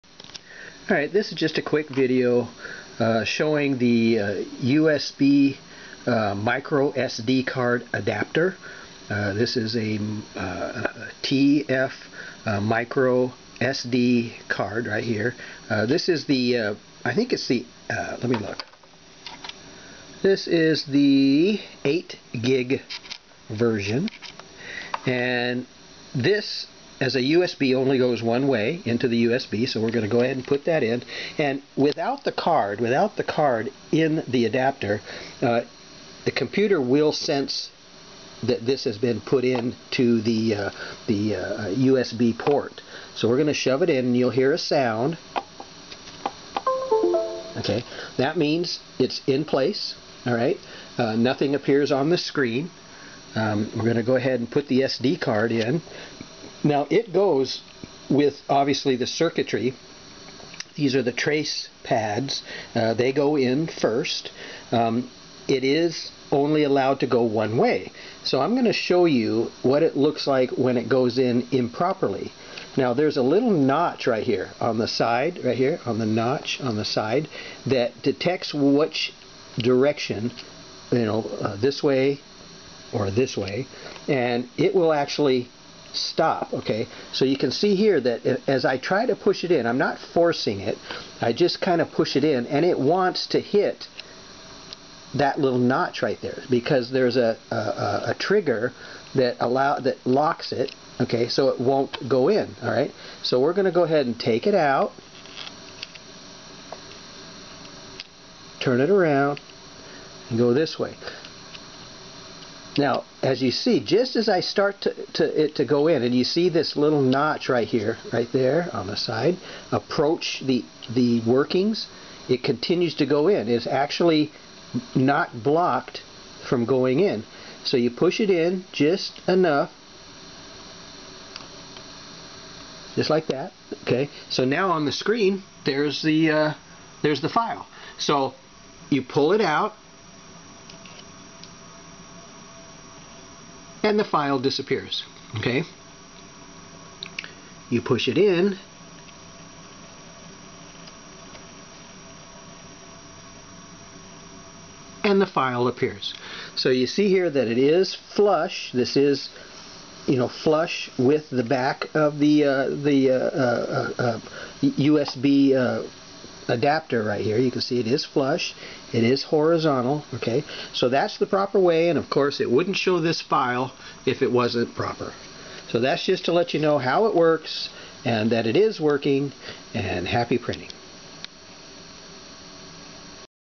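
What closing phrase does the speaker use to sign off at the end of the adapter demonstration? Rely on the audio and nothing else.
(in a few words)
happy printing.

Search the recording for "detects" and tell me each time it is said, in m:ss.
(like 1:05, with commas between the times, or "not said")
1:18.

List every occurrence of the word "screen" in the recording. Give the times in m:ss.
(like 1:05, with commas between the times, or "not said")
0:52, 2:14.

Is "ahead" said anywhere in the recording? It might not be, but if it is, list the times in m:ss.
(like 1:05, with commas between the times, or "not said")
0:30, 0:54, 1:43.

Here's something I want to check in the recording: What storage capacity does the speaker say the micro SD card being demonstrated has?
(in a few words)
8 gig.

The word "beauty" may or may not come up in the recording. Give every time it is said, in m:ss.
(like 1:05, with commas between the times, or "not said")
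not said.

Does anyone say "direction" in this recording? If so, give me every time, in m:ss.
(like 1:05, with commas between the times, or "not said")
1:19.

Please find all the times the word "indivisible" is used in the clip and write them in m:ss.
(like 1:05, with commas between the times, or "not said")
not said.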